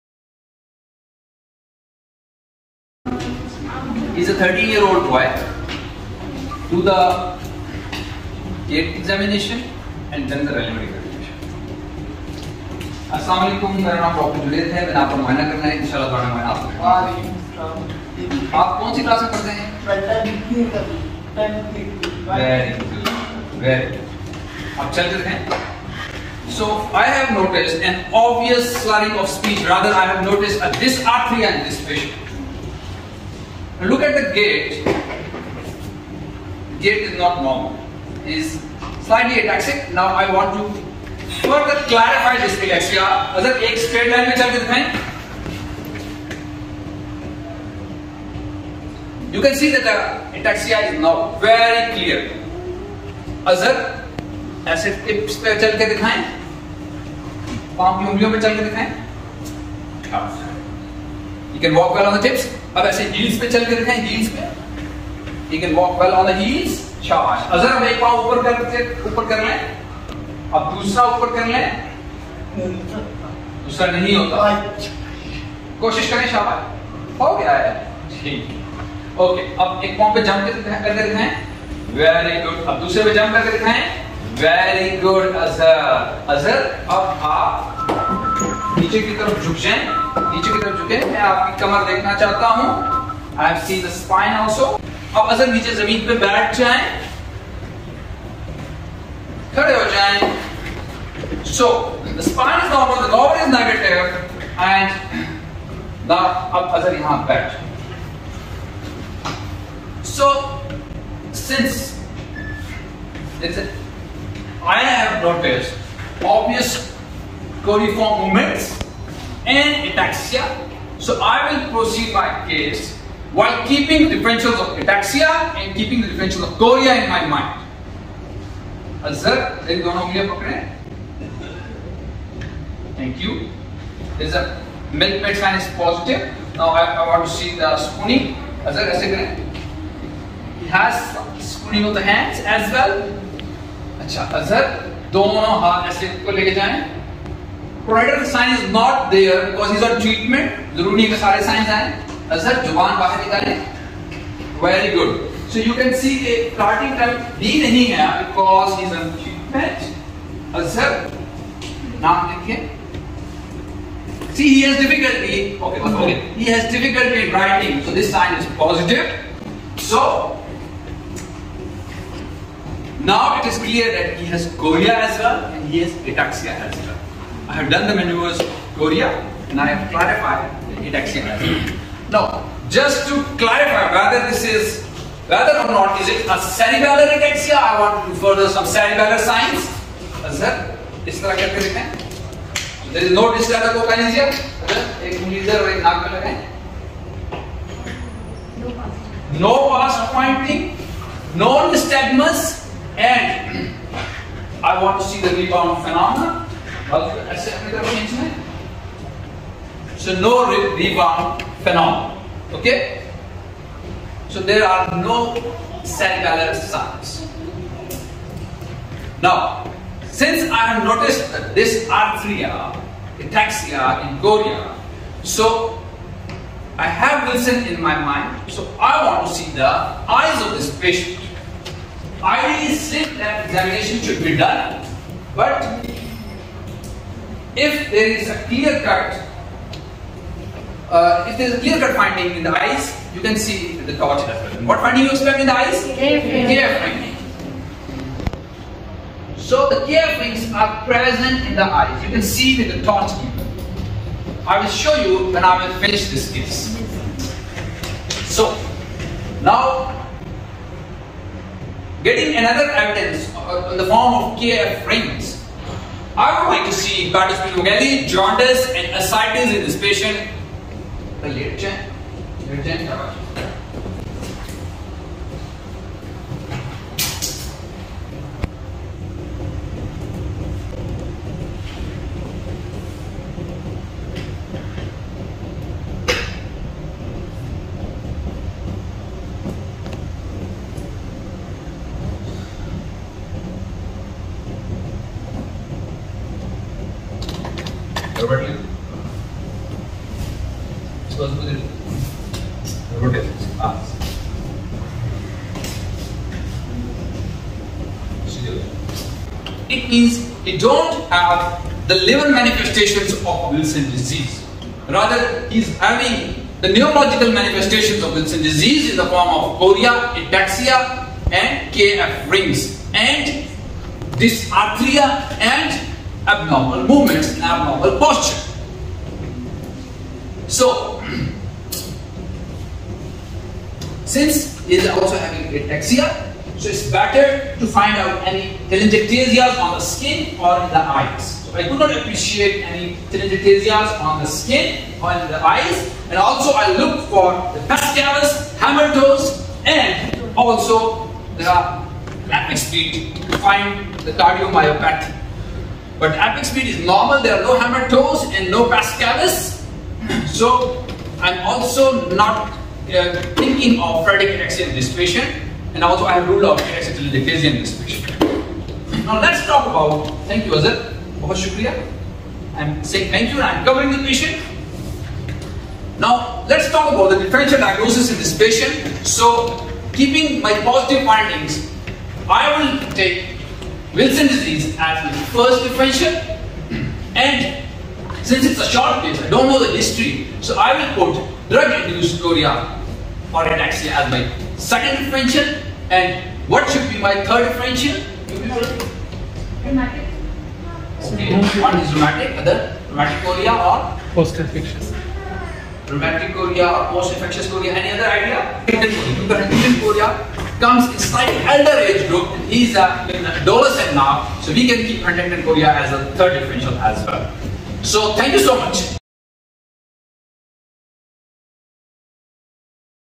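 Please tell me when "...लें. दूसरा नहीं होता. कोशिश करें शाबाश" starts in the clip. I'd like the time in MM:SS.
01:11.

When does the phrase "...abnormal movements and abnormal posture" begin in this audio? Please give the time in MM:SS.
05:26.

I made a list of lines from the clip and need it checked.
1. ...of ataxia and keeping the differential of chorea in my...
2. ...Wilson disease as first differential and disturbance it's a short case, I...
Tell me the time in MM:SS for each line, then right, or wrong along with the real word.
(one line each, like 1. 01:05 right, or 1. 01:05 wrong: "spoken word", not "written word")
1. 02:04 right
2. 06:23 wrong: "since", not "disturbance".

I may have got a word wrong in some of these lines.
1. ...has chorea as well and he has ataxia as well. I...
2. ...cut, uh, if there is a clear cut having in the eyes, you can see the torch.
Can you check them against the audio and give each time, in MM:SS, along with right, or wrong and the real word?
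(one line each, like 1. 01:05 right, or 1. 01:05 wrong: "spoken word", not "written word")
1. 02:54 right
2. 03:58 wrong: "finding", not "having".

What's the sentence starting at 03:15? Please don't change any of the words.
एक उंगली इधर और एक नाक में लगाएं.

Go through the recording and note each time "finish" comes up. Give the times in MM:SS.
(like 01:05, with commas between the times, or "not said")
04:15.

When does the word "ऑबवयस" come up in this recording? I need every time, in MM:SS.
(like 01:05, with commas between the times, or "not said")
01:56.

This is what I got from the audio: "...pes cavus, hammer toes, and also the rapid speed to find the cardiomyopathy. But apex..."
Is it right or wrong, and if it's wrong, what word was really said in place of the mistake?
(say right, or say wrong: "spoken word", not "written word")
right.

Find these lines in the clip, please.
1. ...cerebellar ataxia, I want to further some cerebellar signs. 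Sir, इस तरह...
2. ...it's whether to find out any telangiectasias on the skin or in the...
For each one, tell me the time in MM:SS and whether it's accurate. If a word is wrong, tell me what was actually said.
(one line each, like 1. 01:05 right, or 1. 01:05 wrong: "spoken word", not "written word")
1. 03:06 right
2. 05:36 wrong: "better", not "whether".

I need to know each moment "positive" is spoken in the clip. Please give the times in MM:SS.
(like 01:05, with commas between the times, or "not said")
02:15, 02:48, 06:20.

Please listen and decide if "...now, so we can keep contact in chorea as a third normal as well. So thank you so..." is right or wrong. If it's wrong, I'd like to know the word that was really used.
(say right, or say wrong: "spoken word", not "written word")
wrong: "differential", not "normal".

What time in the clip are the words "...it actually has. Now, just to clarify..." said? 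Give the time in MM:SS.
03:00.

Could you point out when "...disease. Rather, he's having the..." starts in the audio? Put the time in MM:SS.
05:13.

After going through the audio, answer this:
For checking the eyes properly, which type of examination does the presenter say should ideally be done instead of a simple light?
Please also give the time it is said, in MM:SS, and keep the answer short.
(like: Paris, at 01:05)
Slit examination, at 03:52.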